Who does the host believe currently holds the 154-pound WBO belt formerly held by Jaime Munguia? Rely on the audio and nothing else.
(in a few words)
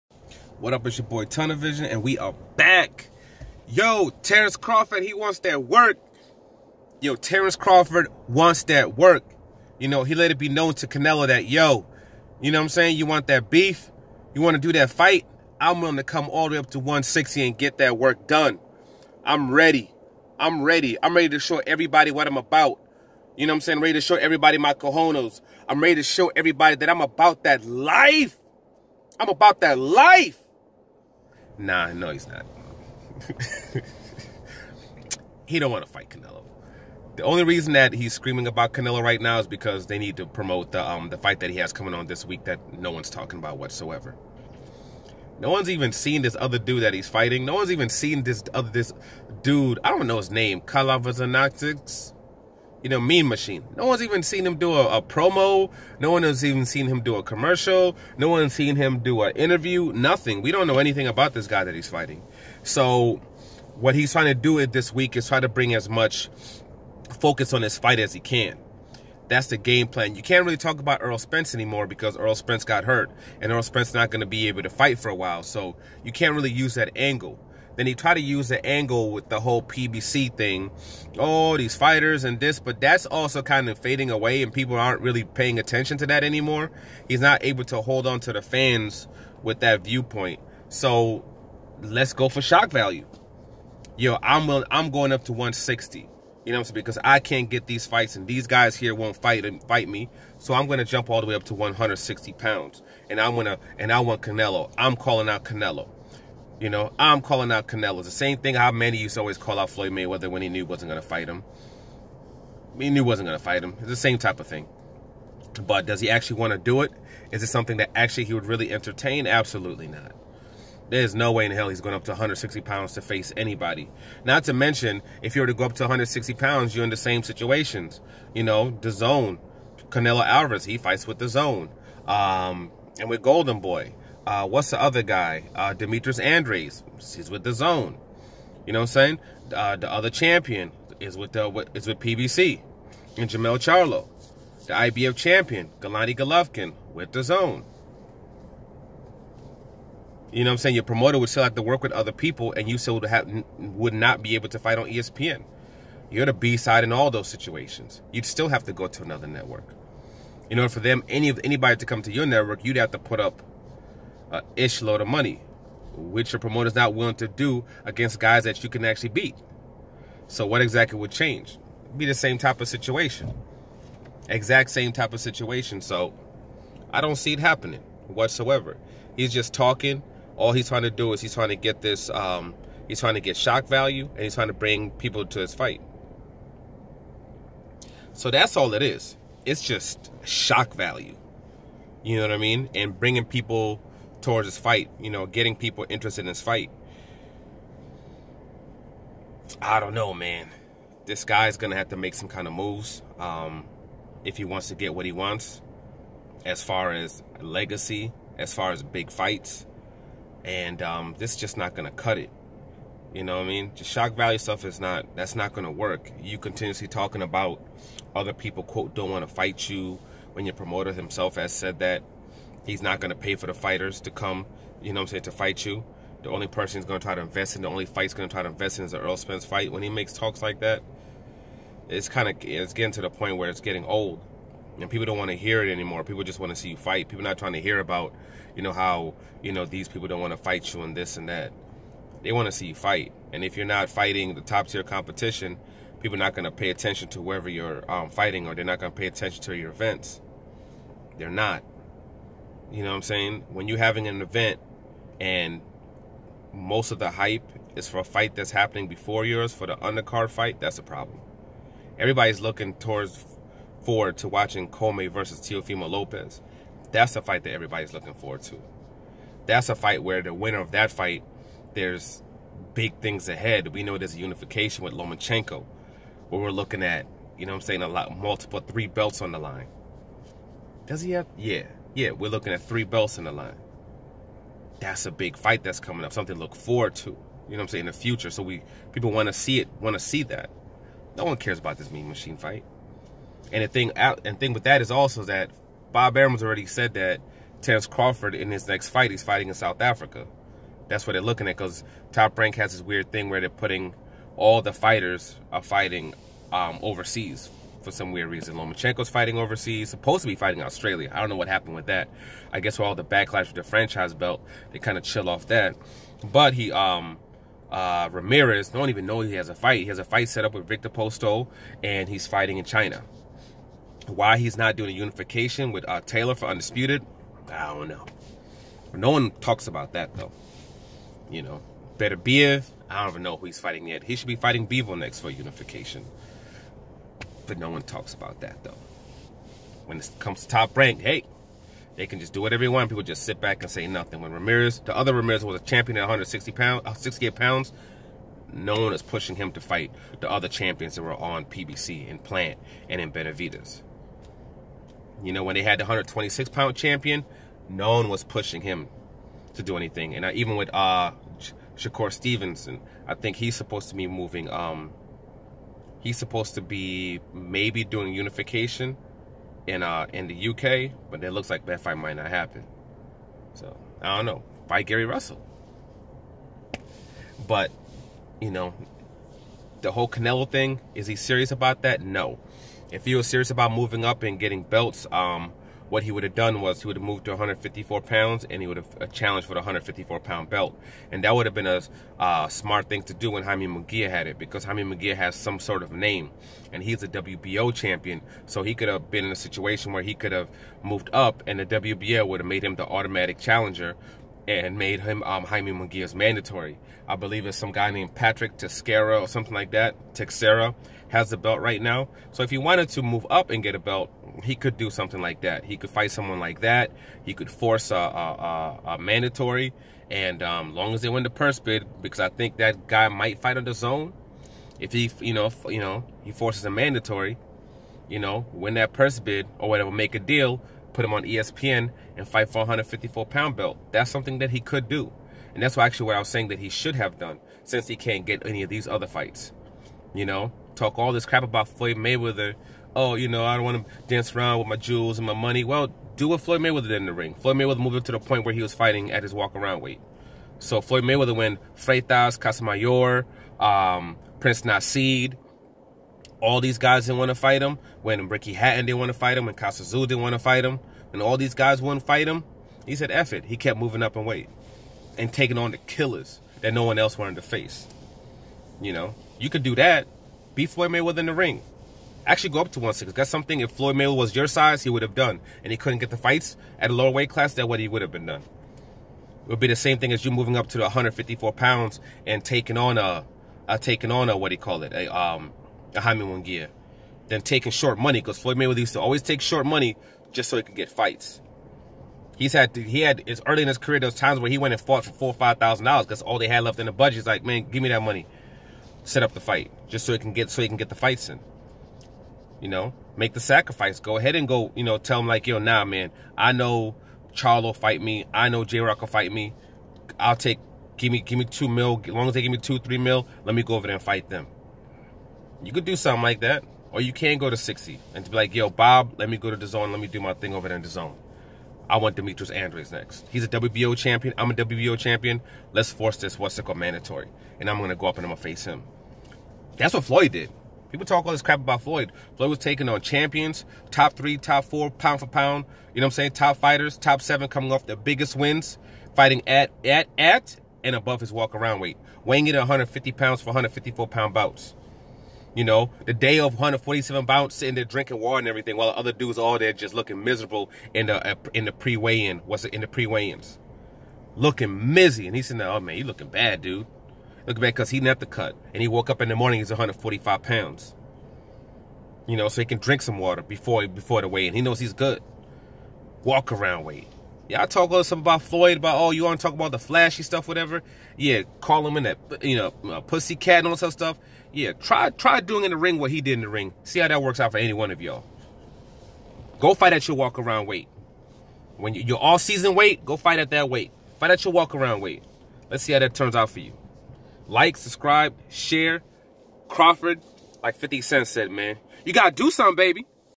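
Patrick Teixeira.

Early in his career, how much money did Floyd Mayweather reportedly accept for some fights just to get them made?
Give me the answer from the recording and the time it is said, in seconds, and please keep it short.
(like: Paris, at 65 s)
4-5 thousand dollars, at 495 s.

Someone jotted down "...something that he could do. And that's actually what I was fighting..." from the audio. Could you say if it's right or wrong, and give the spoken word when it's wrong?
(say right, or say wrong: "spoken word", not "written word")
wrong: "saying", not "fighting".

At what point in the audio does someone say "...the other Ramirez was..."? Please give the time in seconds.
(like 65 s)
344 s.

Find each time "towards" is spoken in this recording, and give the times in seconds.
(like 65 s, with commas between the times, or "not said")
194 s, 262 s.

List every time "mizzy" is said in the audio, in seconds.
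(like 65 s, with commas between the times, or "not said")
554 s.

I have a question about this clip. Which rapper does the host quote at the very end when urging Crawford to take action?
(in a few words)
50 Cent.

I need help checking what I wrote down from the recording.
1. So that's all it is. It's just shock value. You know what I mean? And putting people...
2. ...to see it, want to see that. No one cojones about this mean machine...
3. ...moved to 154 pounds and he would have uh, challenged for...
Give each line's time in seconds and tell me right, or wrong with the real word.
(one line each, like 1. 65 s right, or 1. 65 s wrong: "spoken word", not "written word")
1. 188 s wrong: "bringing", not "putting"
2. 289 s wrong: "cares", not "cojones"
3. 387 s right.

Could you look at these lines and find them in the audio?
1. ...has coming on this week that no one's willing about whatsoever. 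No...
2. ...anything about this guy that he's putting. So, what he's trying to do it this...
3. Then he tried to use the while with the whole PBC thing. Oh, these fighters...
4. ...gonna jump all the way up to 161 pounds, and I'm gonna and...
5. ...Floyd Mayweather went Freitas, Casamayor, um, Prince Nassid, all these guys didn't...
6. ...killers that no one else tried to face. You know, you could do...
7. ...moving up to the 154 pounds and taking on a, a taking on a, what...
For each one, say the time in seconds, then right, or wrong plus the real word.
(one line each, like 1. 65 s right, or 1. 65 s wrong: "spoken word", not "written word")
1. 41 s wrong: "talking", not "willing"
2. 60 s wrong: "fighting", not "putting"
3. 77 s wrong: "angle", not "while"
4. 100 s wrong: "160", not "161"
5. 450 s right
6. 465 s wrong: "wanted", not "tried"
7. 480 s right.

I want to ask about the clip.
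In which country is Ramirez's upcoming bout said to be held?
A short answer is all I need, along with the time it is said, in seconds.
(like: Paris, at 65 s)
China, at 322 s.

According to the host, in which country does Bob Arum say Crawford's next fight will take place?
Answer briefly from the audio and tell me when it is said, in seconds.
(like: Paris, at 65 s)
South Africa, at 299 s.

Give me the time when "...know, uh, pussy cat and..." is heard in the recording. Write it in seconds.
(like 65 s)
572 s.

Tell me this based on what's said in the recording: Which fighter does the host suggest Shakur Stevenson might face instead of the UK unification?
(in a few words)
Gary Russell.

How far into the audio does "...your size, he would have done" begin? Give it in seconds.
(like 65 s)
474 s.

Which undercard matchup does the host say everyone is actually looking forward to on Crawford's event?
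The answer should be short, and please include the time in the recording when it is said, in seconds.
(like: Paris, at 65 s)
Commey versus Teofimo Lopez, at 264 s.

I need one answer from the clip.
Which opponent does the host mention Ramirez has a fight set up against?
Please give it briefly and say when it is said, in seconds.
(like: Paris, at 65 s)
Viktor Postol, at 320 s.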